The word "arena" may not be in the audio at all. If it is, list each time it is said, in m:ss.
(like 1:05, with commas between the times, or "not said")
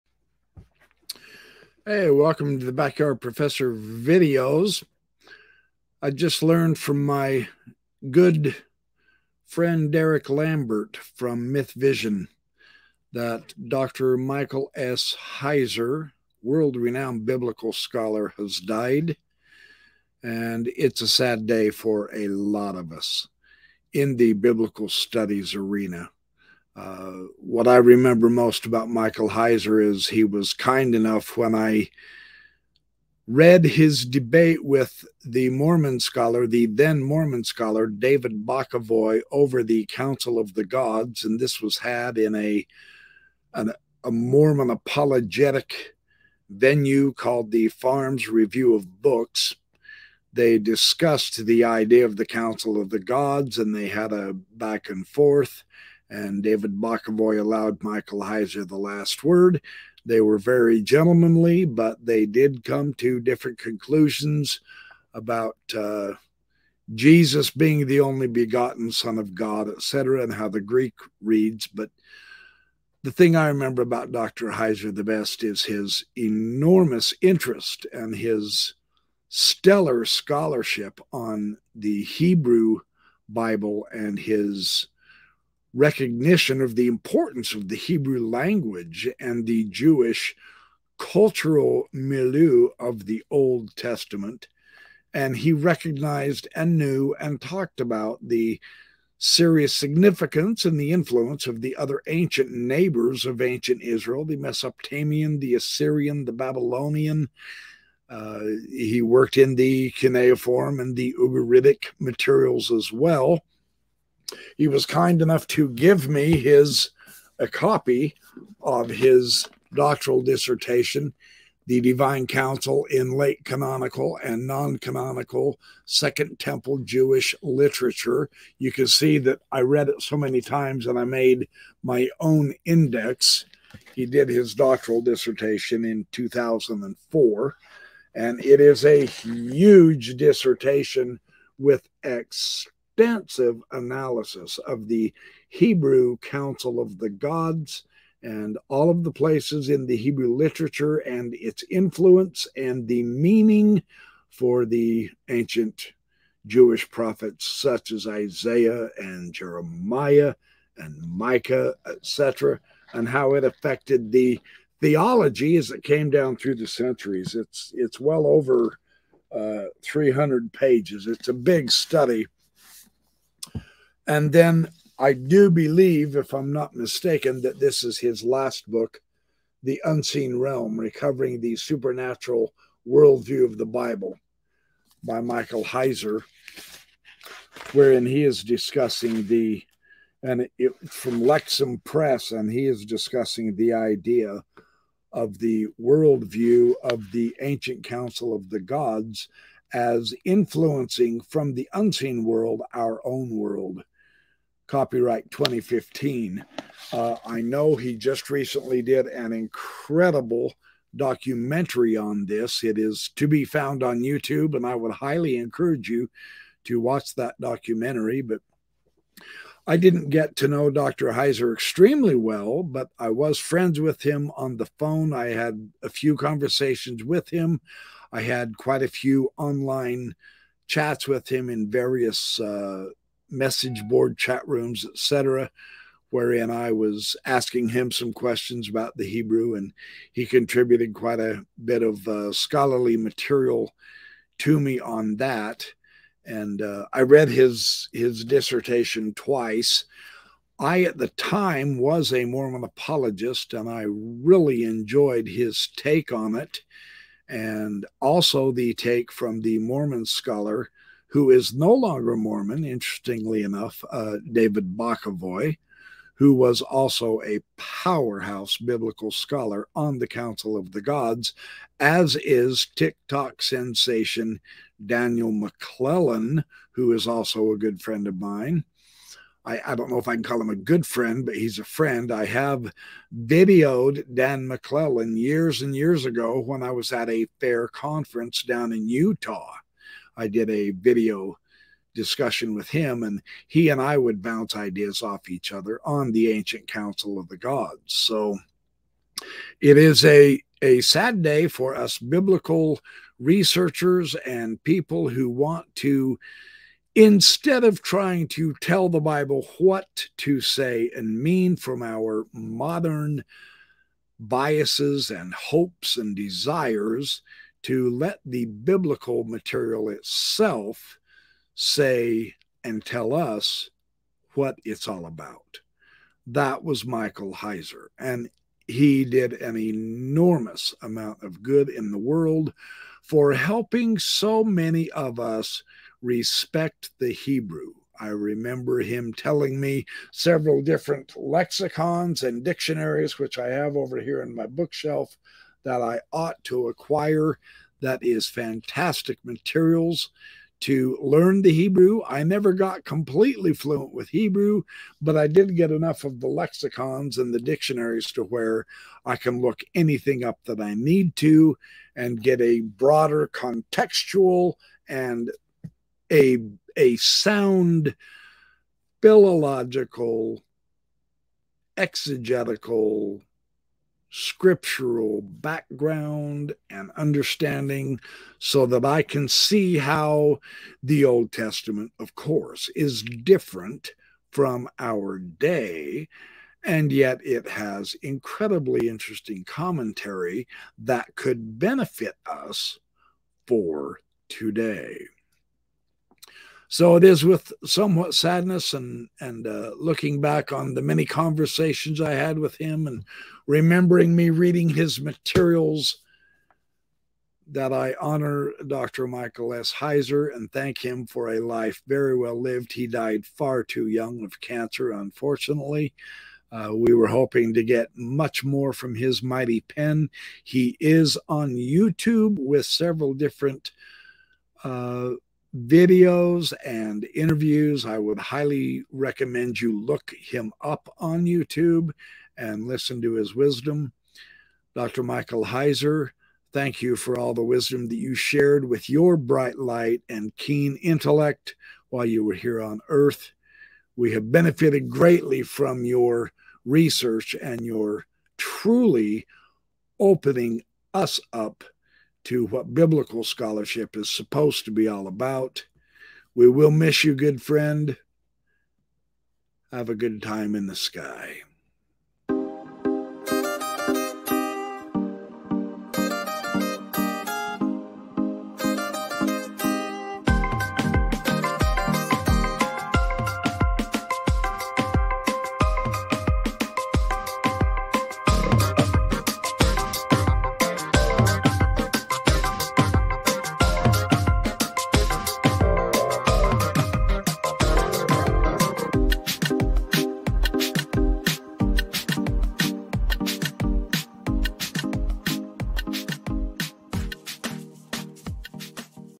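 0:25.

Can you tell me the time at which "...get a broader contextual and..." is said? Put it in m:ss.
6:02.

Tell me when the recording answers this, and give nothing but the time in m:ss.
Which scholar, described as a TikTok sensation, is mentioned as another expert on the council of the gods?
4:34.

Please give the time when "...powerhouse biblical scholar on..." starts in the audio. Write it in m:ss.
4:27.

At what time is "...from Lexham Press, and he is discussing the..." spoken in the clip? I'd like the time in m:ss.
3:10.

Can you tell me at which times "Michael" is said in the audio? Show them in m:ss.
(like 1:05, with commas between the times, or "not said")
0:14, 0:28, 0:57, 3:05, 5:26, 6:49, 7:15.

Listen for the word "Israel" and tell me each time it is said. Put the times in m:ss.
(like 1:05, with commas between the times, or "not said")
1:43.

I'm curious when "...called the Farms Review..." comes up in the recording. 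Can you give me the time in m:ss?
0:47.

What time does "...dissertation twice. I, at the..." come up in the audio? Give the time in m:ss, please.
4:08.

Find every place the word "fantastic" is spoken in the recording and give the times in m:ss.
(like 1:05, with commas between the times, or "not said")
5:48.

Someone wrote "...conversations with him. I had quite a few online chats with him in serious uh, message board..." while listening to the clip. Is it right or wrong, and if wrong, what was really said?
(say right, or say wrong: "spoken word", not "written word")
wrong: "various", not "serious".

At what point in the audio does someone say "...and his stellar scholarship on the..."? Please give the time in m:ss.
1:17.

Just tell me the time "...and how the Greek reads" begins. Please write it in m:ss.
1:10.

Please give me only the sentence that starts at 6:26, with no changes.
And yet it has incredibly interesting commentary that could benefit us for today.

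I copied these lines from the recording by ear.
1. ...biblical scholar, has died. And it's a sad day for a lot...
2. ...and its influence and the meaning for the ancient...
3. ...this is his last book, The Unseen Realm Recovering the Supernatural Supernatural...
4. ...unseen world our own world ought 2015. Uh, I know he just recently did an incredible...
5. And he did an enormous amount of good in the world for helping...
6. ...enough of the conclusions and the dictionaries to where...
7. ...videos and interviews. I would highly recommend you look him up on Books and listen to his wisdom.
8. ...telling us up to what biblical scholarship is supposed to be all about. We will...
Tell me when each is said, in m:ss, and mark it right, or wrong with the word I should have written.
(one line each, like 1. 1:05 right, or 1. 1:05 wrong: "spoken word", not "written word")
1. 0:17 right
2. 2:30 right
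3. 2:57 wrong: "Worldview", not "Supernatural"
4. 3:21 wrong: "copyright", not "ought"
5. 5:27 right
6. 5:55 wrong: "lexicons", not "conclusions"
7. 7:05 wrong: "YouTube", not "Books"
8. 7:29 wrong: "opening", not "telling".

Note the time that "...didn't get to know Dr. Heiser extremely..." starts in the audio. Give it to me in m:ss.
3:39.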